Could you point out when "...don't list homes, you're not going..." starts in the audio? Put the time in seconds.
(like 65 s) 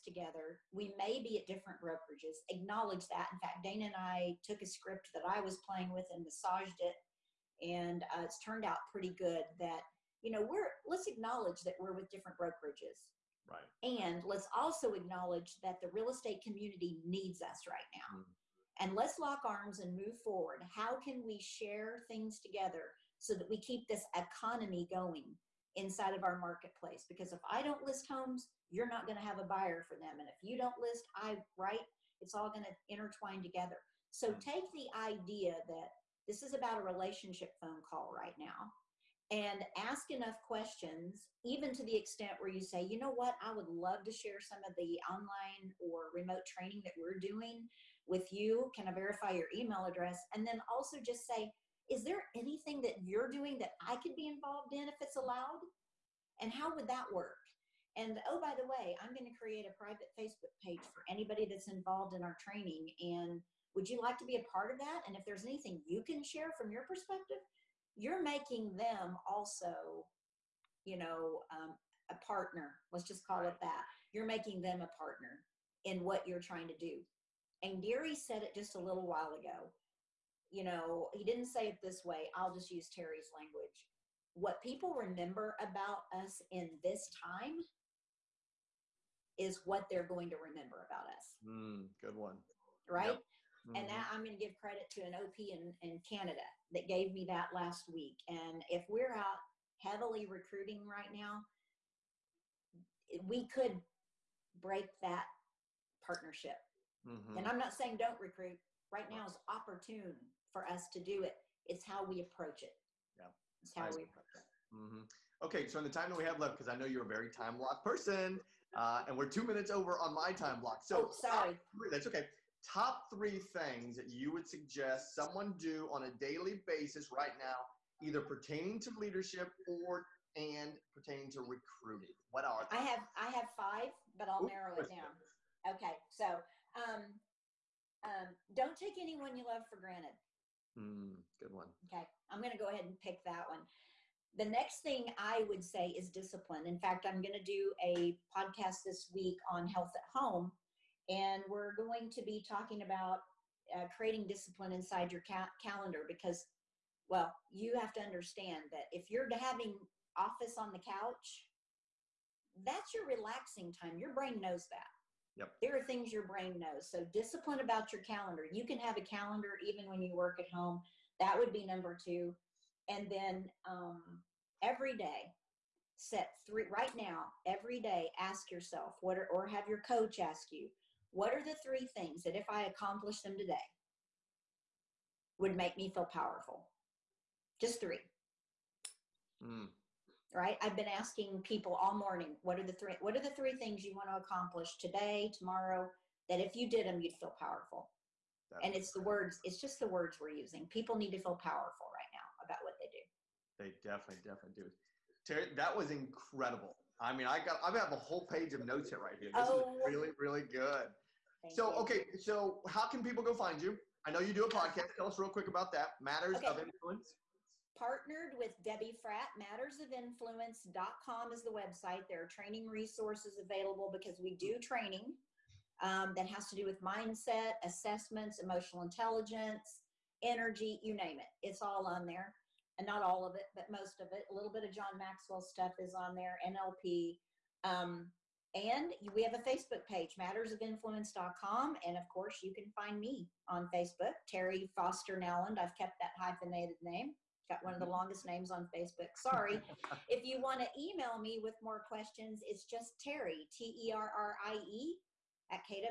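27 s.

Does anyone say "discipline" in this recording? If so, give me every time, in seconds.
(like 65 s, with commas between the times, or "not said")
146 s, 154 s, 167 s.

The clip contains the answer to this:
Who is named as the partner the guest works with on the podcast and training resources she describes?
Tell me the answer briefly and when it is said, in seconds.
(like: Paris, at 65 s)
Debbie Fratt, at 218 s.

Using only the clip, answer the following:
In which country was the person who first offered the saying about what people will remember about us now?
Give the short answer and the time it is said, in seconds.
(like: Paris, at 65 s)
Canada, at 96 s.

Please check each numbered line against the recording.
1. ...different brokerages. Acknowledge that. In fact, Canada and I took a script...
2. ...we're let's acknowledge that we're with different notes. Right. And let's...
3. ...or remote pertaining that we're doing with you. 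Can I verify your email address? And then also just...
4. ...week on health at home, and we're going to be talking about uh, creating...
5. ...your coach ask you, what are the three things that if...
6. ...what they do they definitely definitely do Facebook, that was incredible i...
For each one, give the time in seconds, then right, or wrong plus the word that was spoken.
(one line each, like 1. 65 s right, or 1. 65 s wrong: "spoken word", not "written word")
1. 1 s wrong: "Dana", not "Canada"
2. 10 s wrong: "brokerages", not "notes"
3. 45 s wrong: "training", not "pertaining"
4. 149 s right
5. 179 s right
6. 202 s wrong: "Terri", not "Facebook".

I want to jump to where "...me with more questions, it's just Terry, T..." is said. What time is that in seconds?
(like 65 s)
251 s.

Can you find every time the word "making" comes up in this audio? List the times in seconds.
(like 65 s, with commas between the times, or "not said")
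68 s, 74 s.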